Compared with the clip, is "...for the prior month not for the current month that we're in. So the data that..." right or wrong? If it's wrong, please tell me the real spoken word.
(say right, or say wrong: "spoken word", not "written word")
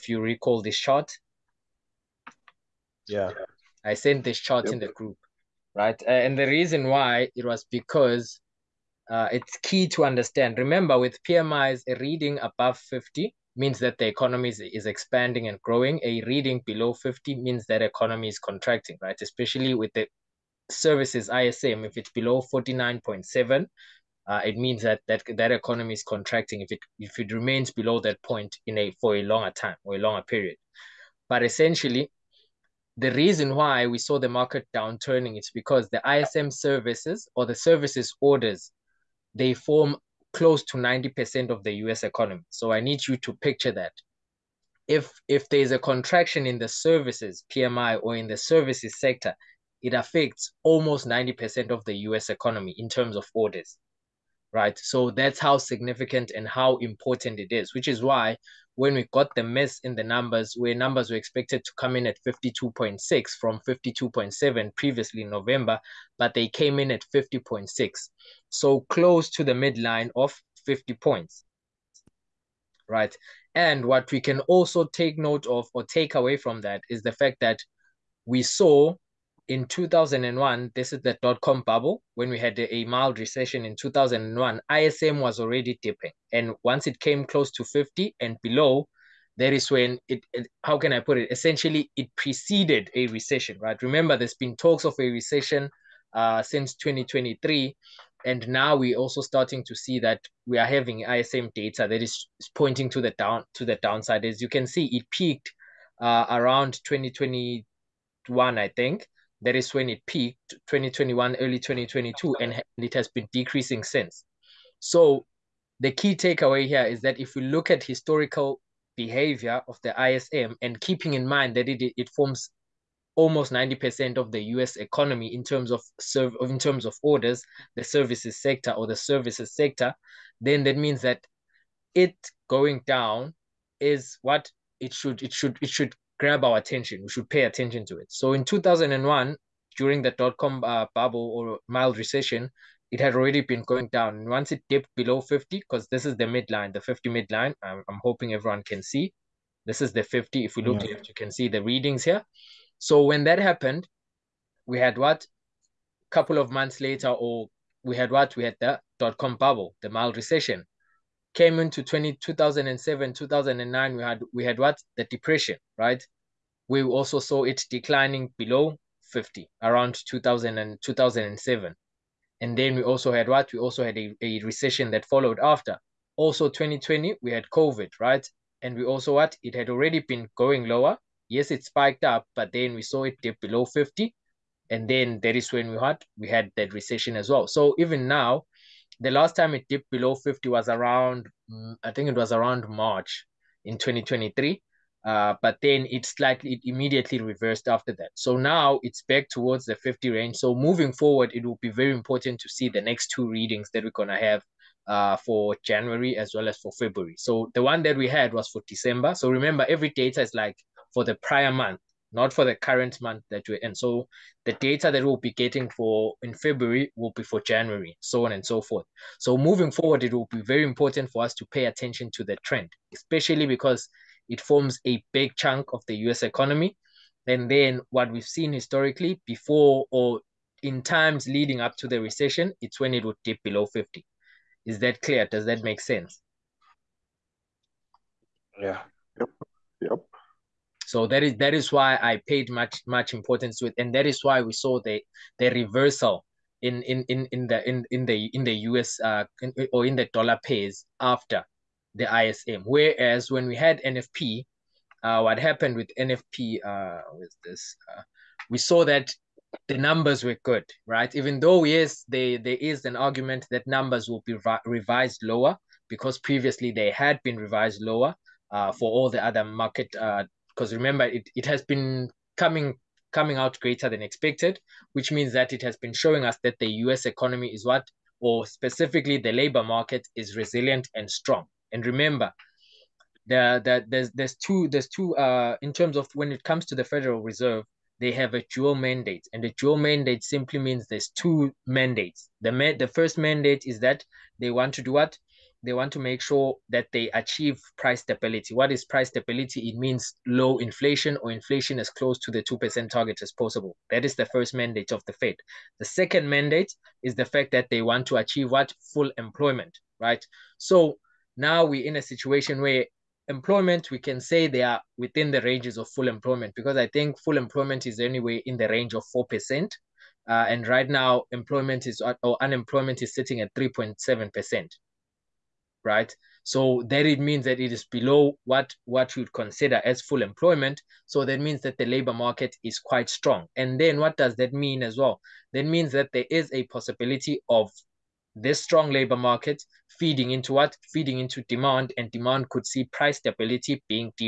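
right.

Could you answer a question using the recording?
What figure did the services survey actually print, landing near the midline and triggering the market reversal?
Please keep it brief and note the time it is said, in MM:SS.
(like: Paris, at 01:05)
50.6, at 01:07.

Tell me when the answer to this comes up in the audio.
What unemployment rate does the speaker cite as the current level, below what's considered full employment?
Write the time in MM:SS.
05:23.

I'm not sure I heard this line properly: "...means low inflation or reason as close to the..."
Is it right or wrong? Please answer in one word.
wrong.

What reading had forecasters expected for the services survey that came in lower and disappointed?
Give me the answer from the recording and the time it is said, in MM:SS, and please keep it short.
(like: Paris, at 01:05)
52.6, at 01:02.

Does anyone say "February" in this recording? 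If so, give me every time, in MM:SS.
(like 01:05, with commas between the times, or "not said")
03:26, 03:36.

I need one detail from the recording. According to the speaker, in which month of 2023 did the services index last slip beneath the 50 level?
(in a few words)
March.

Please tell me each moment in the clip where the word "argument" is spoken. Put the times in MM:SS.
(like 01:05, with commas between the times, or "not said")
04:22.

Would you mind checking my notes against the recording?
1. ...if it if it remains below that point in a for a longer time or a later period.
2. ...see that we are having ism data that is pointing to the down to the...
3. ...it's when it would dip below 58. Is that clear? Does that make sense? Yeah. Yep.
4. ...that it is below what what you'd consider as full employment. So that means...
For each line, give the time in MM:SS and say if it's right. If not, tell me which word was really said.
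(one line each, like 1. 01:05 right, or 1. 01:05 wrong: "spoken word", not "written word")
1. 00:26 wrong: "longer", not "later"
2. 01:39 right
3. 03:52 wrong: "50", not "58"
4. 05:27 right.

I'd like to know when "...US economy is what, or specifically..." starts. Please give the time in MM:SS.
04:36.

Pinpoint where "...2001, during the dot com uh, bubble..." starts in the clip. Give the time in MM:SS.
02:18.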